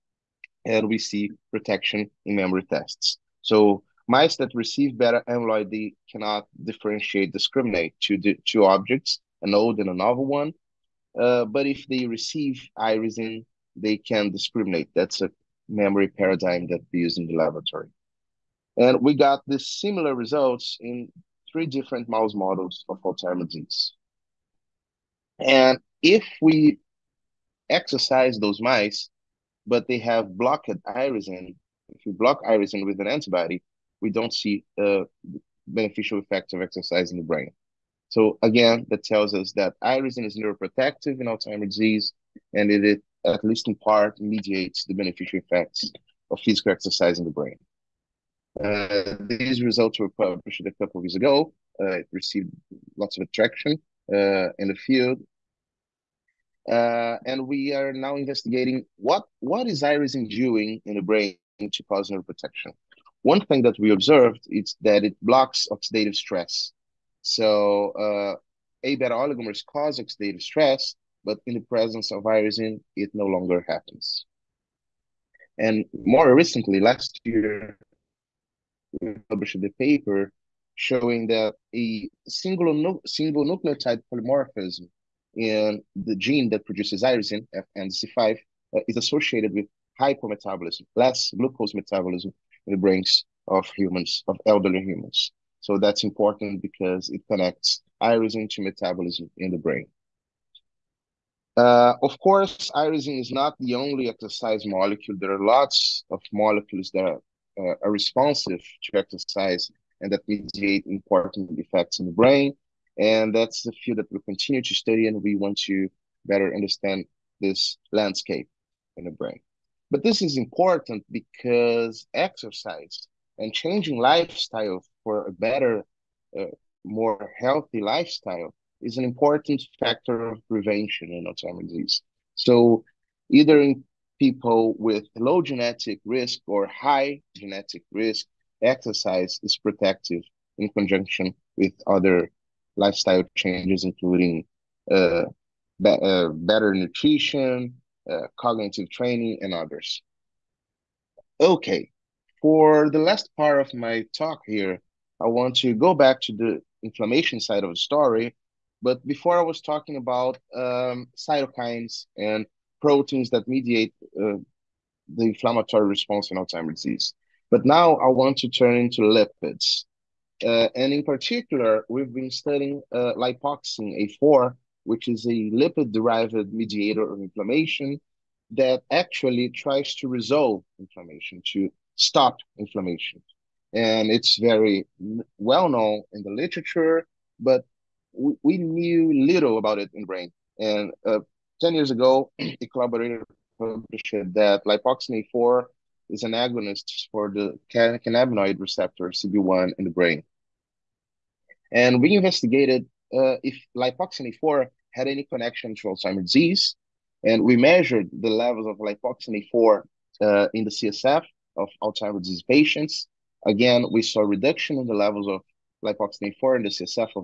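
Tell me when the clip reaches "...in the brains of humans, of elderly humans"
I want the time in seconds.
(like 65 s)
92 s.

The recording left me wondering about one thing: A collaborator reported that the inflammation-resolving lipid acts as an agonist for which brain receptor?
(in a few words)
CB1.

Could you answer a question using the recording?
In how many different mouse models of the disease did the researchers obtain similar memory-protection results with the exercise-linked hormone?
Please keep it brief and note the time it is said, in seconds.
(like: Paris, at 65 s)
3, at 21 s.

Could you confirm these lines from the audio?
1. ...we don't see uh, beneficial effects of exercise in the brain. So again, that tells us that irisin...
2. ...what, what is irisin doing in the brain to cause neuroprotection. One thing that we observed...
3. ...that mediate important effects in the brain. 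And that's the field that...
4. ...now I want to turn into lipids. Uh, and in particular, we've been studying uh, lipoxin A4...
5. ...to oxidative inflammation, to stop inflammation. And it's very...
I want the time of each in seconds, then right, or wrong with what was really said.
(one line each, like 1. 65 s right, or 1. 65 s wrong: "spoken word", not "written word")
1. 34 s right
2. 58 s right
3. 110 s right
4. 167 s right
5. 179 s wrong: "resolve", not "oxidative".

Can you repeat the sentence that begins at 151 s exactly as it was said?
Okay, for the last part of my talk here, I want to go back to the inflammation side of the story.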